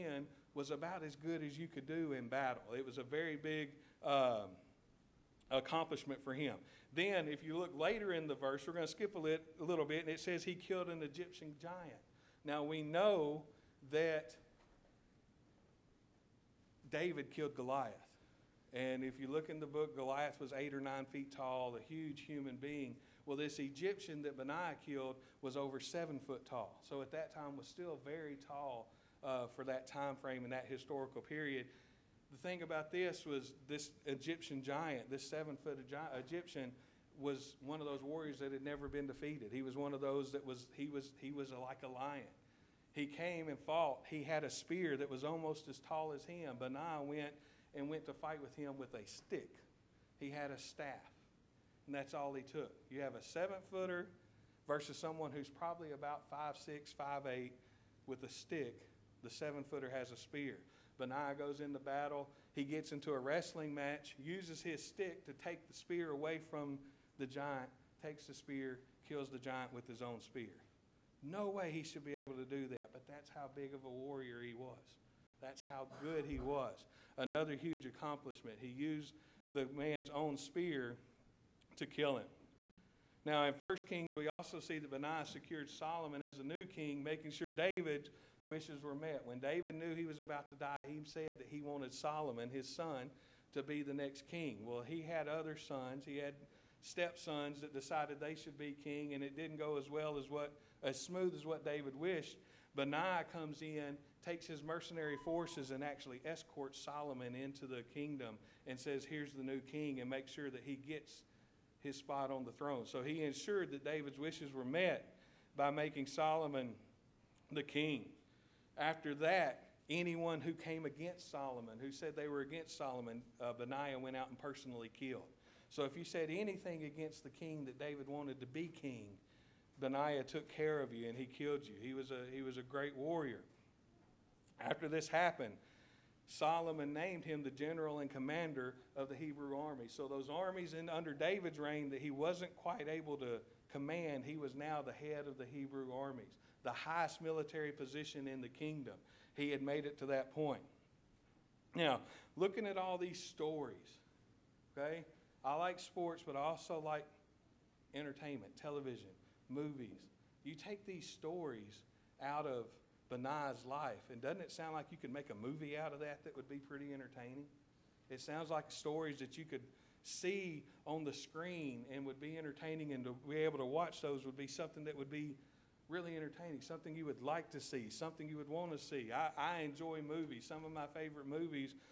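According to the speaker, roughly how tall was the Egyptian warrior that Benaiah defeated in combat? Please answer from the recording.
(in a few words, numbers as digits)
over 7 feet.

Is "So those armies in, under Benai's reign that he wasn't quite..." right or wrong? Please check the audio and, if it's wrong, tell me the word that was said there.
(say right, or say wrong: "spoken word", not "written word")
wrong: "David", not "Benai".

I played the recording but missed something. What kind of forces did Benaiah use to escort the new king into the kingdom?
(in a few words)
mercenary forces.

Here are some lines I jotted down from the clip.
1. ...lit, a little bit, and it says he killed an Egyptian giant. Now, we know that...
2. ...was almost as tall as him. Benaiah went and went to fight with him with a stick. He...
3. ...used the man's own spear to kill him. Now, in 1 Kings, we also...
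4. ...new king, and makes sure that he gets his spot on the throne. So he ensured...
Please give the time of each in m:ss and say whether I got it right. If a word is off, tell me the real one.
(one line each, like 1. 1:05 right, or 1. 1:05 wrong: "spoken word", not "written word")
1. 0:09 right
2. 0:45 right
3. 1:18 right
4. 1:49 right.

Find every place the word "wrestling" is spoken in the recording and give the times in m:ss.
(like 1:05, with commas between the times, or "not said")
1:03.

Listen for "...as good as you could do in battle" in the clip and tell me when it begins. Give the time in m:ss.
0:01.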